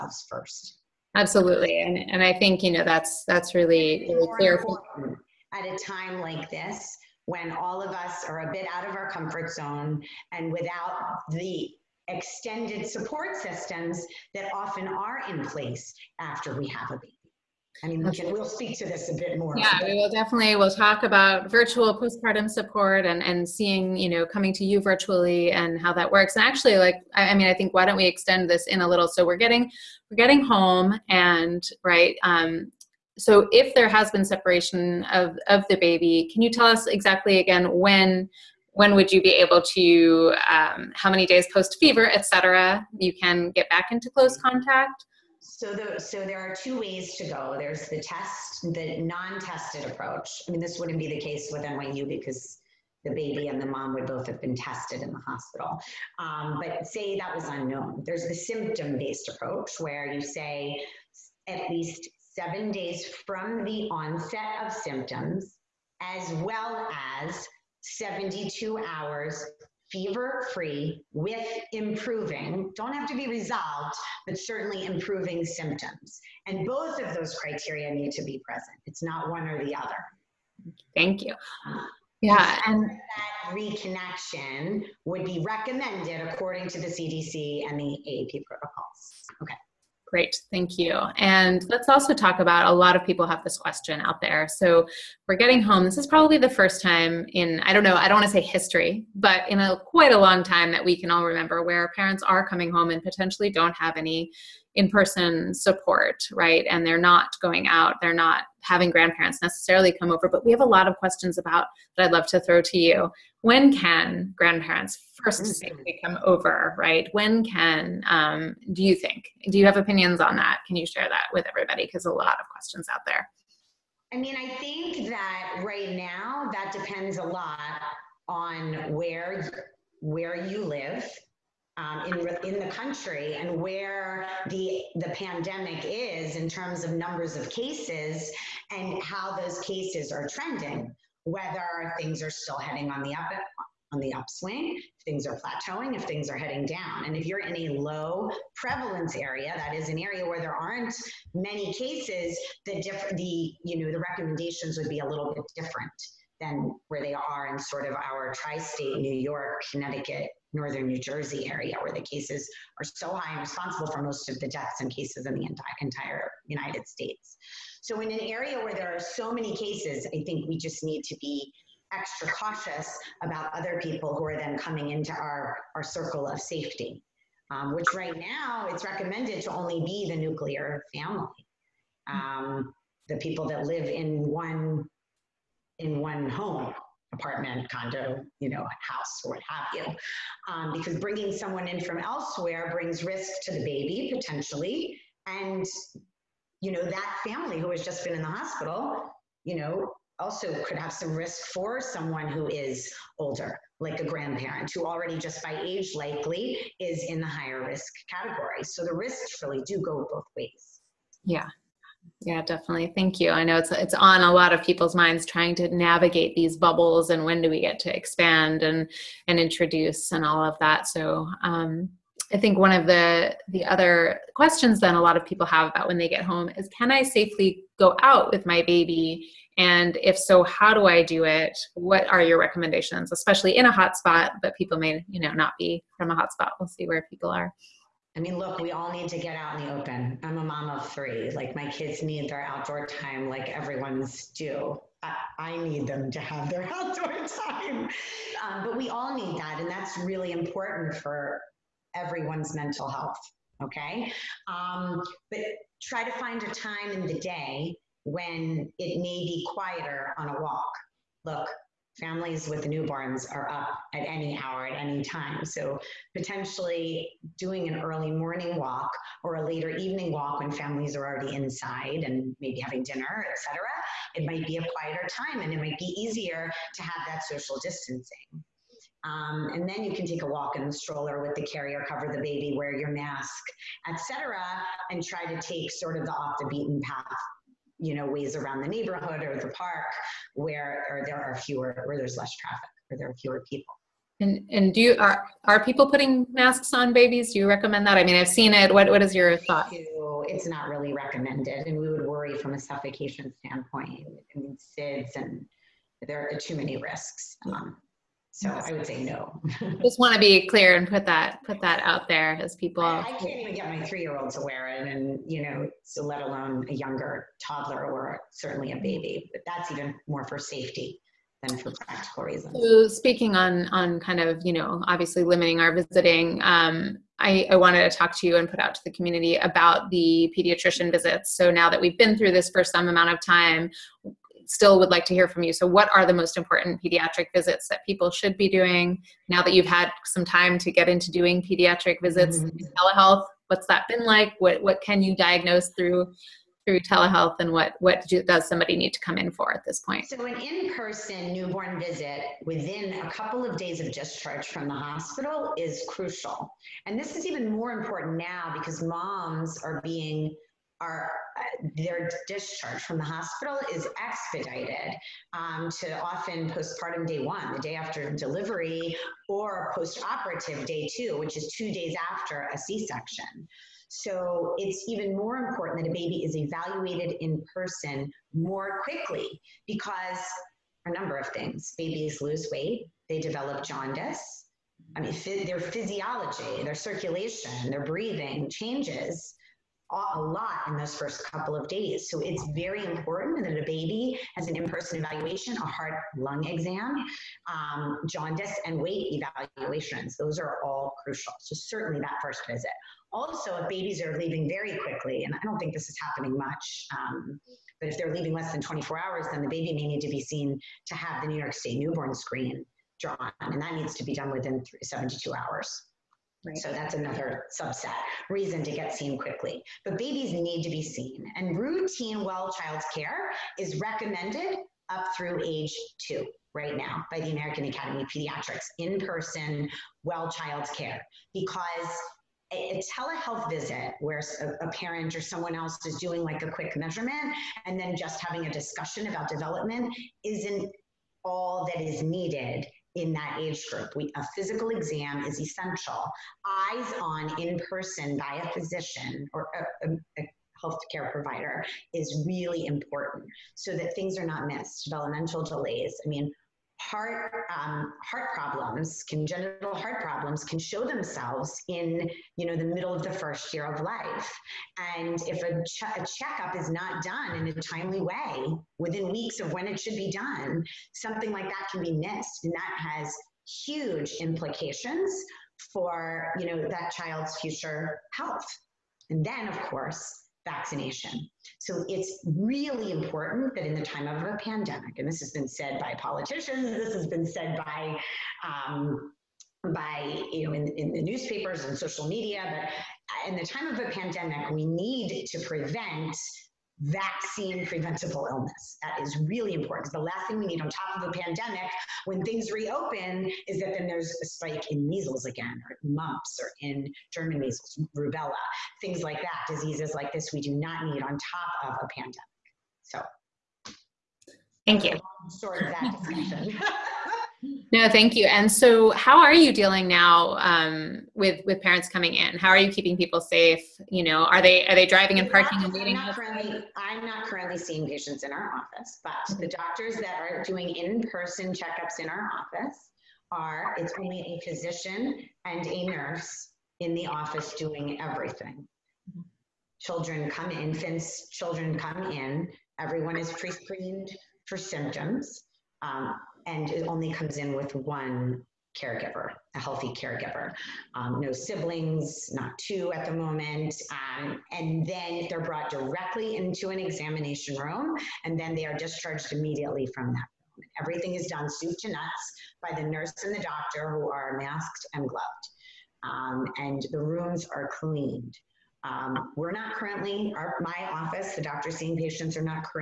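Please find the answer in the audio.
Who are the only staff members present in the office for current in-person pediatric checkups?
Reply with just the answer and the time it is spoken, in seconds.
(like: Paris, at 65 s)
A physician and a nurse, at 534 s.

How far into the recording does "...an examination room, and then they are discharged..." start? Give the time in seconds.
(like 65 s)
556 s.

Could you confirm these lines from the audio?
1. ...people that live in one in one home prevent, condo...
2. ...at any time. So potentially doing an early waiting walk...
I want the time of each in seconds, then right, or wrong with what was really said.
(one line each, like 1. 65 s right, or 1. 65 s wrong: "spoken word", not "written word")
1. 183 s wrong: "apartment", not "prevent"
2. 264 s wrong: "morning", not "waiting".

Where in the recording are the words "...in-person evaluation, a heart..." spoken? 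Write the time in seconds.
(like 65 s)
394 s.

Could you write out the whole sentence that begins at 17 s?
I mean, we we'll speak to this a bit more.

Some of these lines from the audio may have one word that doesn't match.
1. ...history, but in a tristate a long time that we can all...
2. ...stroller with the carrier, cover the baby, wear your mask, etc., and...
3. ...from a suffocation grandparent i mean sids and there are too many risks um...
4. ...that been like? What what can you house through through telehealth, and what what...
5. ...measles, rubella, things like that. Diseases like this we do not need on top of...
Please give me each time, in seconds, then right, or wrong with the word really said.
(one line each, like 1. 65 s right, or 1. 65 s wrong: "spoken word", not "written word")
1. 98 s wrong: "quite", not "tristate"
2. 280 s right
3. 302 s wrong: "standpoint", not "grandparent"
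4. 343 s wrong: "diagnose", not "house"
5. 507 s right.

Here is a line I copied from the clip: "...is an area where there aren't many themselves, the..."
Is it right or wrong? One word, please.
wrong.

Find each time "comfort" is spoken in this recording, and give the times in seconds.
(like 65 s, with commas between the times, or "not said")
9 s.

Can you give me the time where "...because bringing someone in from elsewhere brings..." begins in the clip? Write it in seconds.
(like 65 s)
190 s.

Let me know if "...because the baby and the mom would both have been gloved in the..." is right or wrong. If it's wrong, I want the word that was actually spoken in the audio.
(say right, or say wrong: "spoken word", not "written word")
wrong: "tested", not "gloved".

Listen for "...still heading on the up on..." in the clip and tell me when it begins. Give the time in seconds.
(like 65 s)
142 s.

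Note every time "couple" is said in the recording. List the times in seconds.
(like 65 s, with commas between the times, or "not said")
353 s, 391 s.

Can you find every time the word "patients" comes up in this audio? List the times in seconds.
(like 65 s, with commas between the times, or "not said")
527 s, 571 s.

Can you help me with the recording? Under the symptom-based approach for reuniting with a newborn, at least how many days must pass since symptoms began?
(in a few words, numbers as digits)
7.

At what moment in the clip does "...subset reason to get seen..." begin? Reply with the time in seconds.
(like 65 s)
417 s.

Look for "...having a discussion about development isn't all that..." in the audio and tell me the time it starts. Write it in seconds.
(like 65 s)
438 s.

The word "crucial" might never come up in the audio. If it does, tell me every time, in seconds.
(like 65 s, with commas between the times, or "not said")
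355 s, 401 s.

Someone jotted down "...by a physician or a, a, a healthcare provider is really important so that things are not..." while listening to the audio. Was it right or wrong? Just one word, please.
right.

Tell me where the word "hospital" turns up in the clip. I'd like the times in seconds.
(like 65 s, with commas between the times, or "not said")
55 s, 198 s, 354 s, 363 s.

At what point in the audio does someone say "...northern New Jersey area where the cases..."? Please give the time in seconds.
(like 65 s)
160 s.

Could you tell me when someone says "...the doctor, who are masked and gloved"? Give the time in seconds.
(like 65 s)
563 s.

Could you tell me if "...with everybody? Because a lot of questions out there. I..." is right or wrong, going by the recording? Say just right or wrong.
right.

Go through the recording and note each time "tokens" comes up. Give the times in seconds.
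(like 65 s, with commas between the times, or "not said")
not said.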